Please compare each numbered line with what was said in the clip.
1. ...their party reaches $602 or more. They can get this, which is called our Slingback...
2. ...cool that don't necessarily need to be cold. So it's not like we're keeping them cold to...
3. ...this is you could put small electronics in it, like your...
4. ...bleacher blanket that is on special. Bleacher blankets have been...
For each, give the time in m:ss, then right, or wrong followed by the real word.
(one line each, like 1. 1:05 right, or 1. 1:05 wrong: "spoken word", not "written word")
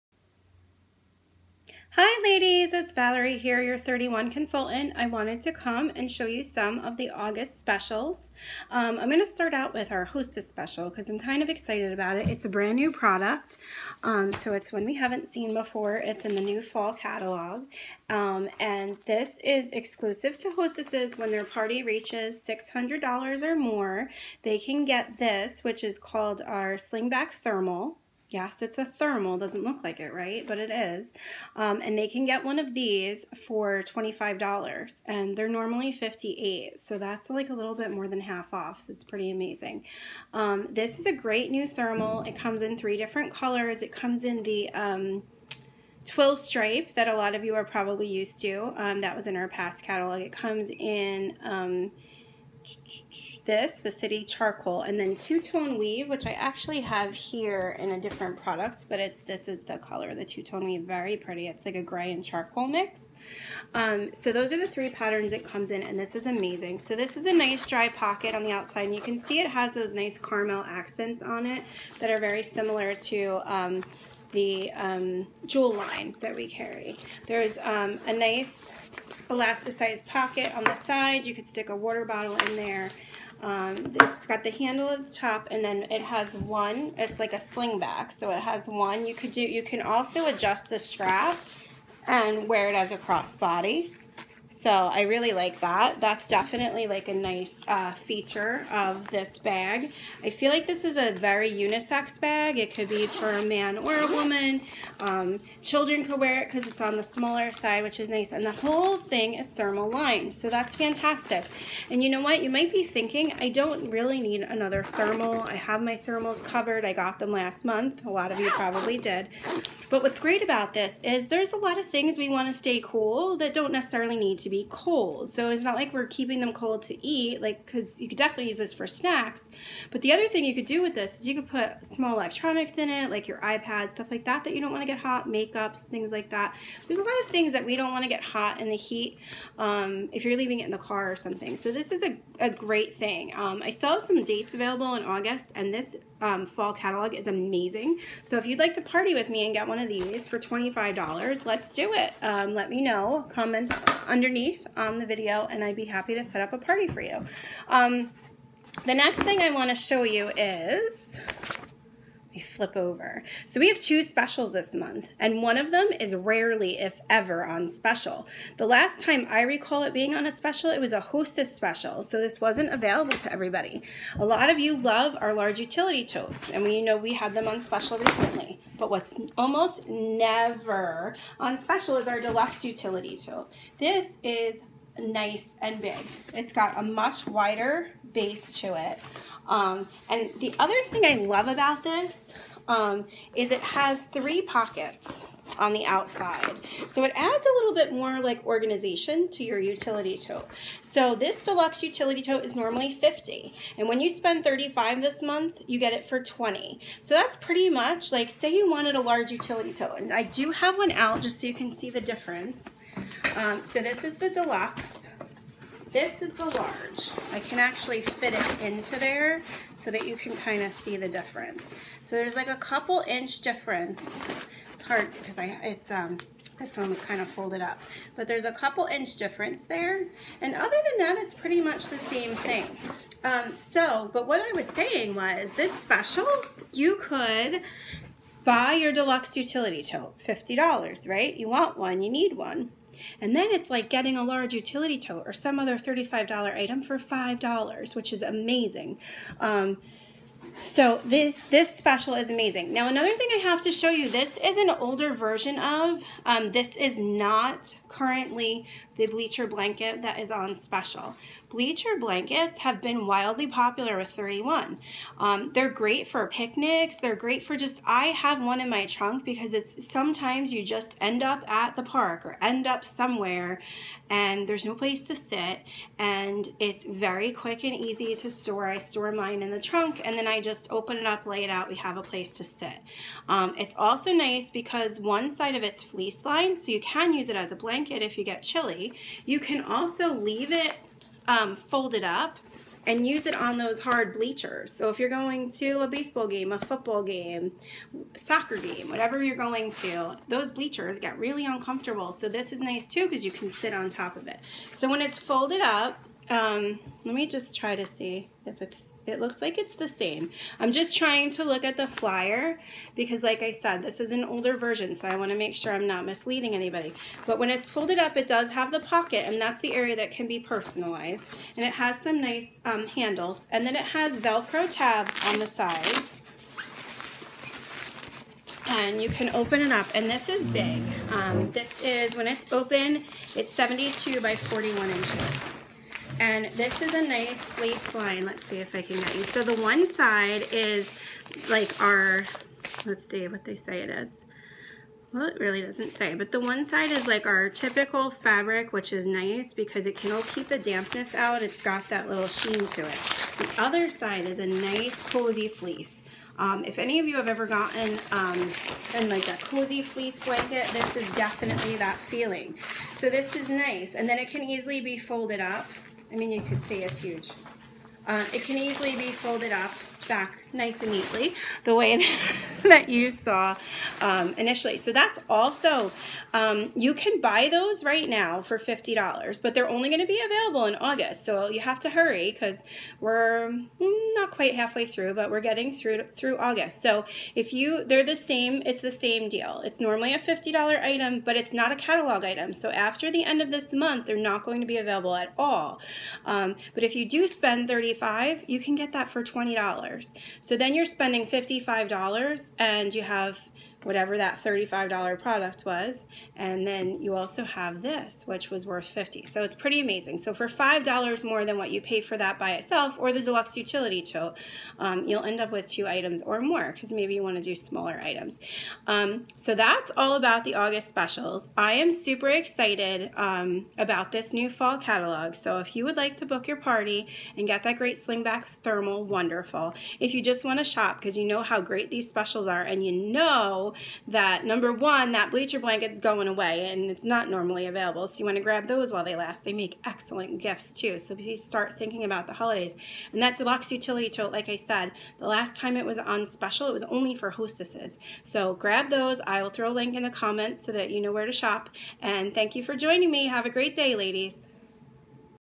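1. 0:21 wrong: "600", not "602"
2. 2:02 right
3. 2:10 right
4. 4:19 right.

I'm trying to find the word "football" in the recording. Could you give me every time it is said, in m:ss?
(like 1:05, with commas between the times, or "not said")
4:56.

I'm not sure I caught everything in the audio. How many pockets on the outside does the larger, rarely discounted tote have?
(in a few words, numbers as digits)
3.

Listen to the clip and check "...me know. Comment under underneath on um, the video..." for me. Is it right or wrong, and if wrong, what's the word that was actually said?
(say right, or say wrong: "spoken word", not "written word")
right.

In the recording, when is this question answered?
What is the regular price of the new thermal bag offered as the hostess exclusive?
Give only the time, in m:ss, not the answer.
0:35.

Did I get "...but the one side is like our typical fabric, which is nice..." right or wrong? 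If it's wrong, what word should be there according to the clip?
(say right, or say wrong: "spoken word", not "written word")
right.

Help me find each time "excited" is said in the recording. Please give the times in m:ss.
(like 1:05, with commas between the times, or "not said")
0:11, 7:02.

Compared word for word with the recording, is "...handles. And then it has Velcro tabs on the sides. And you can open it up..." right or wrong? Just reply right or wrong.
right.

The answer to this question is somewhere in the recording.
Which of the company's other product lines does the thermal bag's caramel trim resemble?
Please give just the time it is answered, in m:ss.
1:15.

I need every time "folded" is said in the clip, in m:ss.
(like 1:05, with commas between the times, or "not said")
3:47, 4:51, 5:05, 5:17, 6:04, 6:09.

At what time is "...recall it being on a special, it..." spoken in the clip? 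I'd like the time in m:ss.
2:49.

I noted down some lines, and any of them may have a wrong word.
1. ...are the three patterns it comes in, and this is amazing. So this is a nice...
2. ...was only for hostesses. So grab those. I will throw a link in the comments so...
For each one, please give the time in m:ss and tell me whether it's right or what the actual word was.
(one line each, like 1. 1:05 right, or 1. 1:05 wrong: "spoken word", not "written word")
1. 1:04 right
2. 7:26 right.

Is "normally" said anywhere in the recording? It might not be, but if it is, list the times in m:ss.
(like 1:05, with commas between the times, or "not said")
0:35, 3:22, 6:29, 7:17.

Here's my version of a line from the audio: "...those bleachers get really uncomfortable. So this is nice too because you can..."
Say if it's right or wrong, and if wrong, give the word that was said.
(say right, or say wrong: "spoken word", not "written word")
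right.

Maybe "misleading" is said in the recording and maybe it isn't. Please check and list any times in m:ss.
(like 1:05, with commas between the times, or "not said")
5:16.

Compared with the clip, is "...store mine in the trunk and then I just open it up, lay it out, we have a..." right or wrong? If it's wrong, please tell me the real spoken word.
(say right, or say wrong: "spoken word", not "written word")
right.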